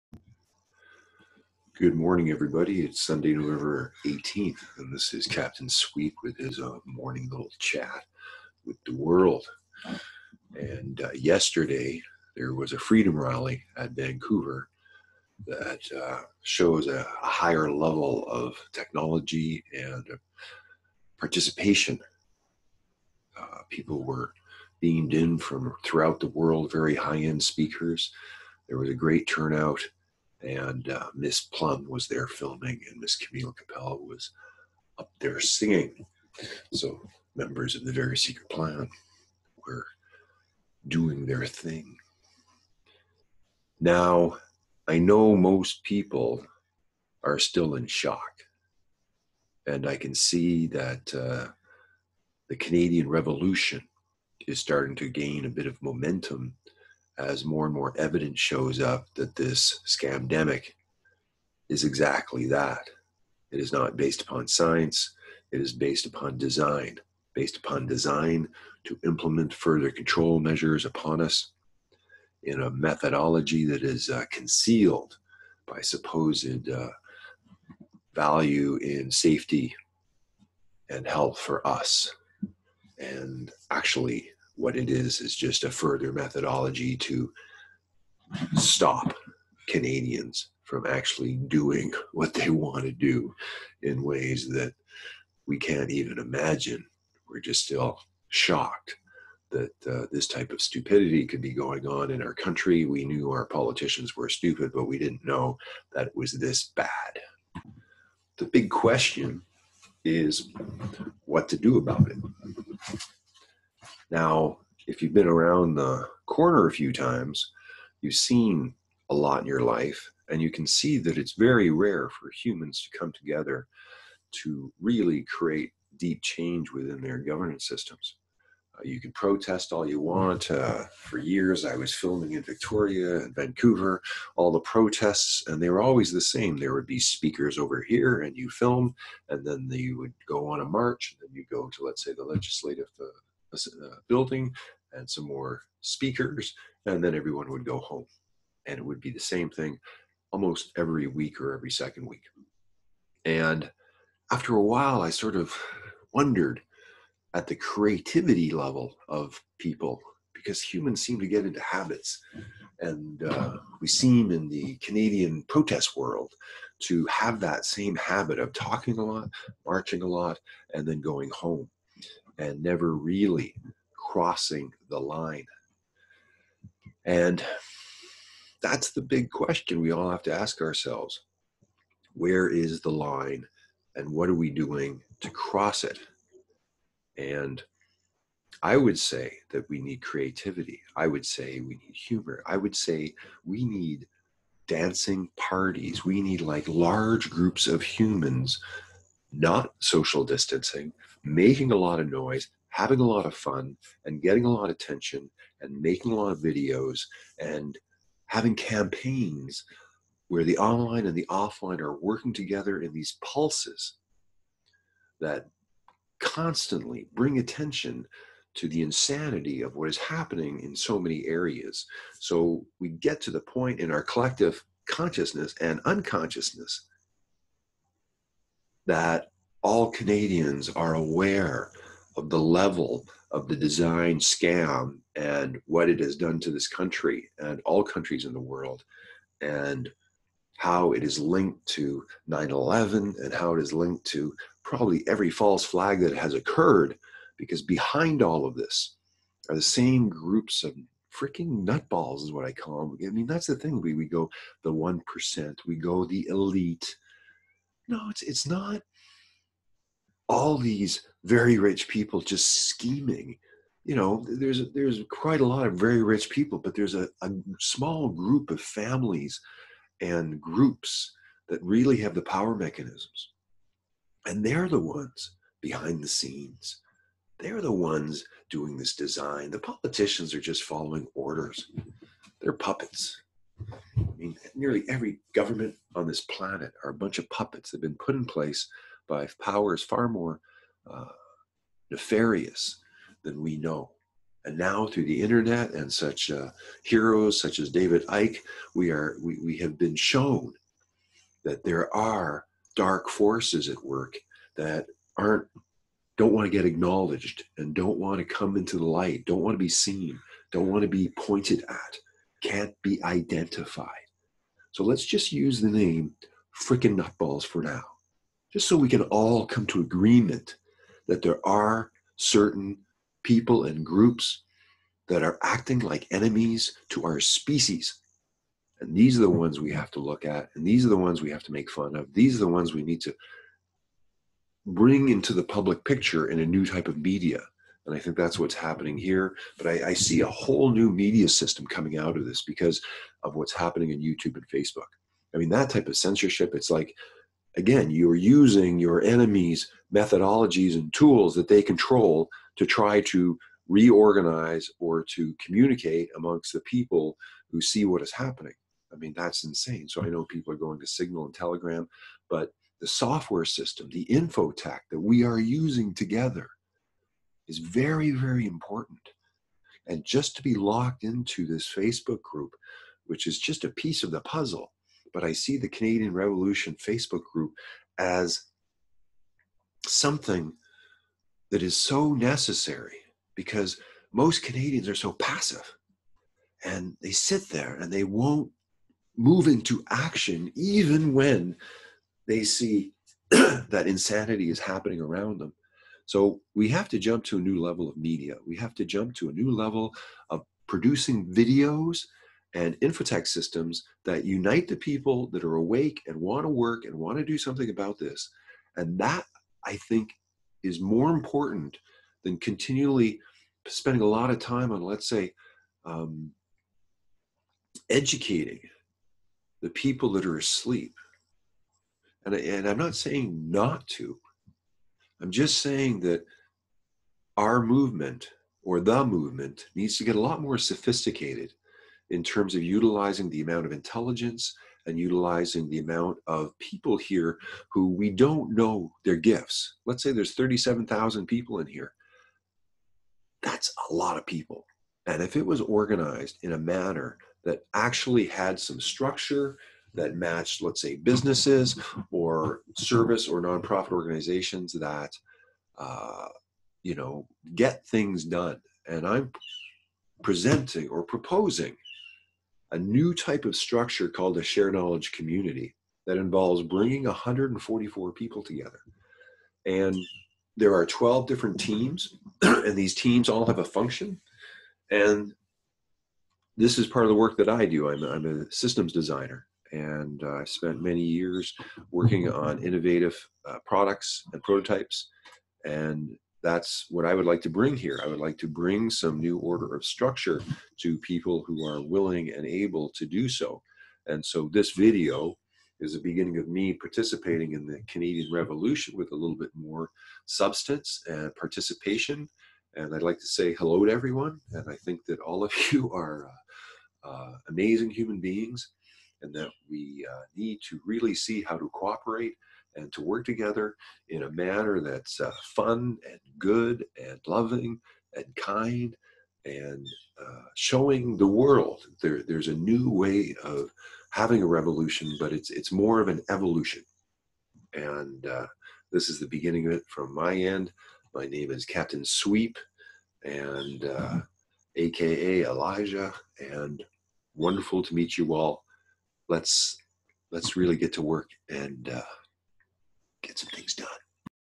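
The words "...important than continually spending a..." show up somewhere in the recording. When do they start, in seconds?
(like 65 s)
411 s.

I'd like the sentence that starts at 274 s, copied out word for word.
And they're the ones behind the scenes.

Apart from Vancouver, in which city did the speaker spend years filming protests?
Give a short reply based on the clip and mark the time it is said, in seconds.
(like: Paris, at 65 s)
Victoria, at 132 s.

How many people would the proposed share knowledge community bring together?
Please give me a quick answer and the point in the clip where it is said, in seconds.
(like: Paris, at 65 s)
144, at 467 s.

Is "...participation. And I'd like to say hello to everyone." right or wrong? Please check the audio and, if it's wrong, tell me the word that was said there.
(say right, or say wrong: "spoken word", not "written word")
right.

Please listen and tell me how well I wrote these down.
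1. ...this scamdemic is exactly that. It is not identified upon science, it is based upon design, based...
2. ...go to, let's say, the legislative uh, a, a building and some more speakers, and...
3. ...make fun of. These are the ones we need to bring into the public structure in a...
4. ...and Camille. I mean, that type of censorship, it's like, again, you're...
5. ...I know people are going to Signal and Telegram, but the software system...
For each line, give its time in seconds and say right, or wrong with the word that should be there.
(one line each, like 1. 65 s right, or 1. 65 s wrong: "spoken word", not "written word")
1. 59 s wrong: "based", not "identified"
2. 141 s right
3. 331 s wrong: "picture", not "structure"
4. 344 s wrong: "Facebook", not "Camille"
5. 360 s right.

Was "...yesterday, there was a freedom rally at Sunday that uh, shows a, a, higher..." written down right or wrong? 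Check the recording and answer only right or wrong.
wrong.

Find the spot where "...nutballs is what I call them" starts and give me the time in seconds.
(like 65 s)
251 s.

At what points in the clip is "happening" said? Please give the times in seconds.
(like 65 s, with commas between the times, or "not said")
219 s, 338 s, 343 s, 358 s, 394 s.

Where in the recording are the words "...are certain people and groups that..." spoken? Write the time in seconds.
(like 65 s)
321 s.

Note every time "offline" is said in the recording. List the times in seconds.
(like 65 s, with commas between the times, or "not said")
211 s.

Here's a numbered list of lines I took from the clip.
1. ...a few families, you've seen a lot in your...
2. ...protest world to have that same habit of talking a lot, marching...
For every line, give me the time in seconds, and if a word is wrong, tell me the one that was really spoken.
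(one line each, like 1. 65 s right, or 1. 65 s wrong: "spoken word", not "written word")
1. 116 s wrong: "times", not "families"
2. 165 s right.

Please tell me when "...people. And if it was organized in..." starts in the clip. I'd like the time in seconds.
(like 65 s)
444 s.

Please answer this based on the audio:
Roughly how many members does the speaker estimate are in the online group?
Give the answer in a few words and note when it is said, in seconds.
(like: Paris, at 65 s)
37,000, at 440 s.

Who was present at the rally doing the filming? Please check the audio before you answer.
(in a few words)
Miss Plum.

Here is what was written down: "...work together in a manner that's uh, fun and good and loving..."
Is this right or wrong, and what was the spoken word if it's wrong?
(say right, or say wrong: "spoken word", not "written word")
right.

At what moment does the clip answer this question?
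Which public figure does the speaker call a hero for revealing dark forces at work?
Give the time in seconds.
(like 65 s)
297 s.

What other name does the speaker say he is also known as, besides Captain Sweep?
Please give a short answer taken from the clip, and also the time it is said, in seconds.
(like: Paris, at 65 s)
Elijah, at 535 s.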